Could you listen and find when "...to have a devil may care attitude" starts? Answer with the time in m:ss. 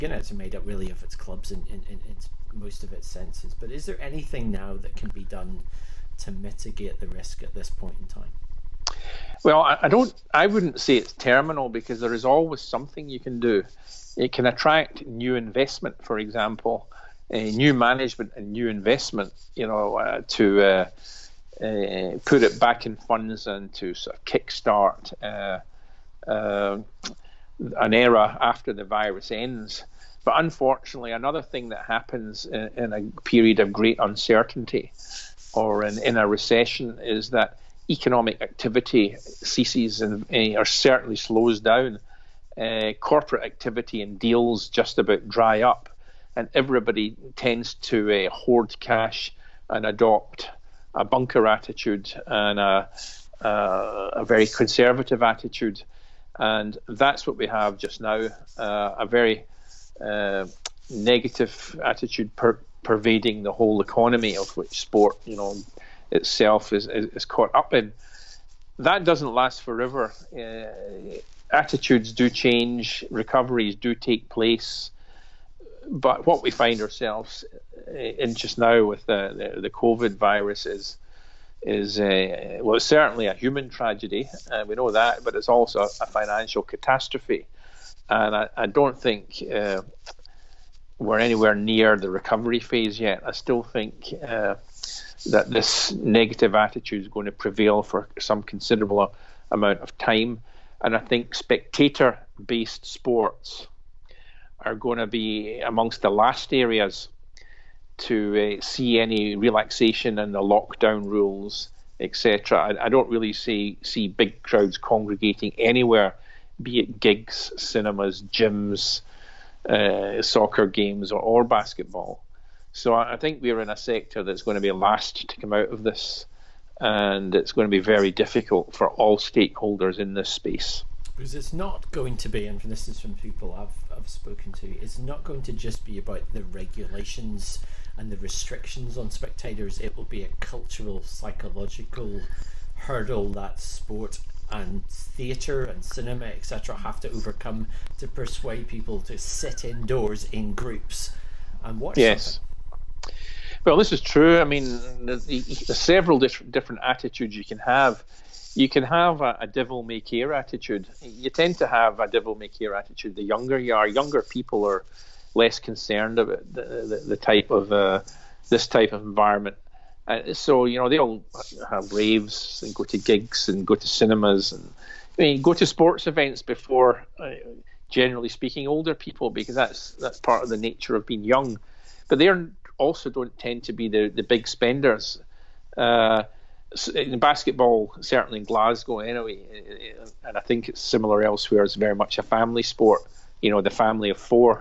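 2:41.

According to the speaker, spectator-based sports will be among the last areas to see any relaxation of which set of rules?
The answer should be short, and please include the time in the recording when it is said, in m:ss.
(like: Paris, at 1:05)
Lockdown rules, at 1:50.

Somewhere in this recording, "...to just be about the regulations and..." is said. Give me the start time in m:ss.
2:15.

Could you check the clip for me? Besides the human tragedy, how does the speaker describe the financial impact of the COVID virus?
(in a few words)
A financial catastrophe.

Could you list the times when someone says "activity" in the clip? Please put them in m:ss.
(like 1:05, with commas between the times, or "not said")
0:38, 0:43.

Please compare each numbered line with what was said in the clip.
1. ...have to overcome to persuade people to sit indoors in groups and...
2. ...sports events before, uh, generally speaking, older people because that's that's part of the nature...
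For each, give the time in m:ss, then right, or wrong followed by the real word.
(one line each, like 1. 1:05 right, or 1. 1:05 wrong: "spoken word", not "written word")
1. 2:26 right
2. 2:55 right.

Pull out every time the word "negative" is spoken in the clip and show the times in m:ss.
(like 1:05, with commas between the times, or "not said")
1:00, 1:35.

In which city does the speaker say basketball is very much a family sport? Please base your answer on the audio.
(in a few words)
Glasgow.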